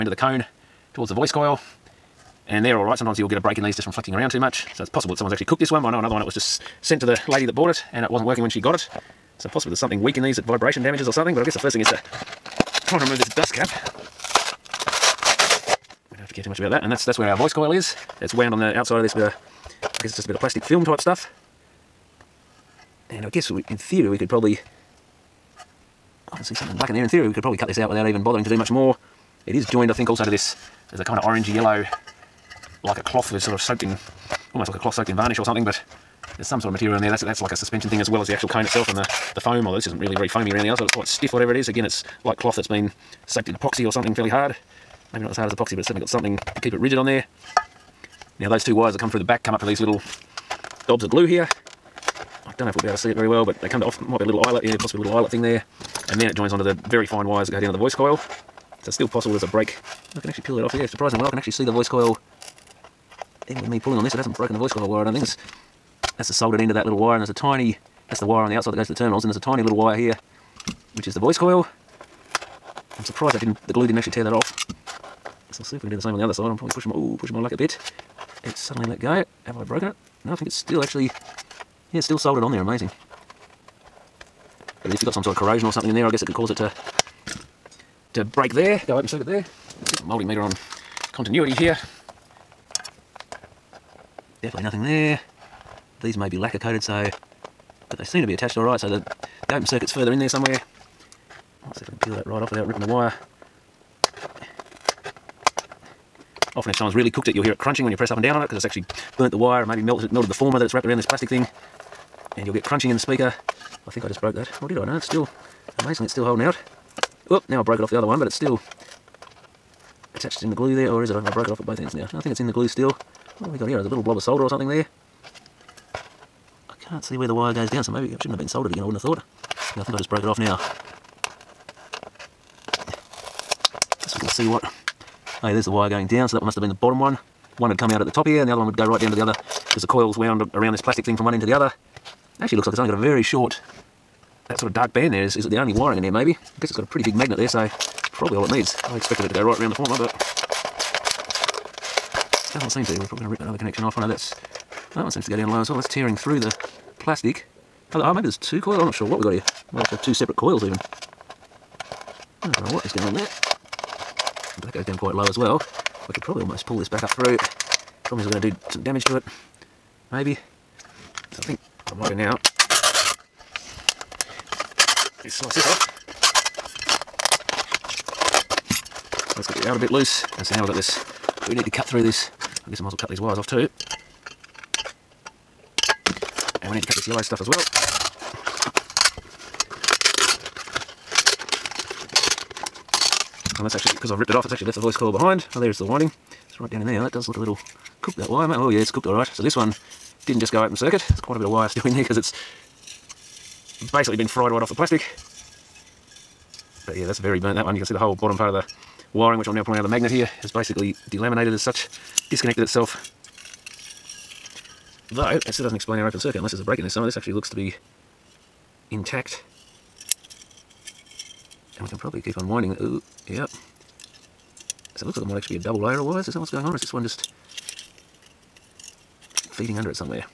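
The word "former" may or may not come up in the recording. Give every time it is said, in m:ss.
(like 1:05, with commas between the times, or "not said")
1:50, 2:29.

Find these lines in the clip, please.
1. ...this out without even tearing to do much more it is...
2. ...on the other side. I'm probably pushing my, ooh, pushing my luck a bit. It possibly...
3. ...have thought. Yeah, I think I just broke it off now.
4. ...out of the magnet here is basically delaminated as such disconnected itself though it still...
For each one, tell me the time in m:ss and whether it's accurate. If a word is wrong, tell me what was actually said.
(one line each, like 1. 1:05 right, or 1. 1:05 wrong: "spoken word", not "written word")
1. 0:27 wrong: "bothering", not "tearing"
2. 1:16 wrong: "suddenly", not "possibly"
3. 2:08 right
4. 3:29 right.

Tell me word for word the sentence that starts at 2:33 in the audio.
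I oh, know that's that one seems to go down low as well.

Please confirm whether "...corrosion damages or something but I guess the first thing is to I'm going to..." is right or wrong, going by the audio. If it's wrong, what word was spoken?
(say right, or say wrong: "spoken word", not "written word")
wrong: "vibration", not "corrosion".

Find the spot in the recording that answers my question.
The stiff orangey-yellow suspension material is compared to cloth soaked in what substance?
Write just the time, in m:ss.
0:35.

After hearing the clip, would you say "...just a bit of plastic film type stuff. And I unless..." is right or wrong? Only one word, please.
wrong.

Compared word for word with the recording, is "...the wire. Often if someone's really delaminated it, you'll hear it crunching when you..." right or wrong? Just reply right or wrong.
wrong.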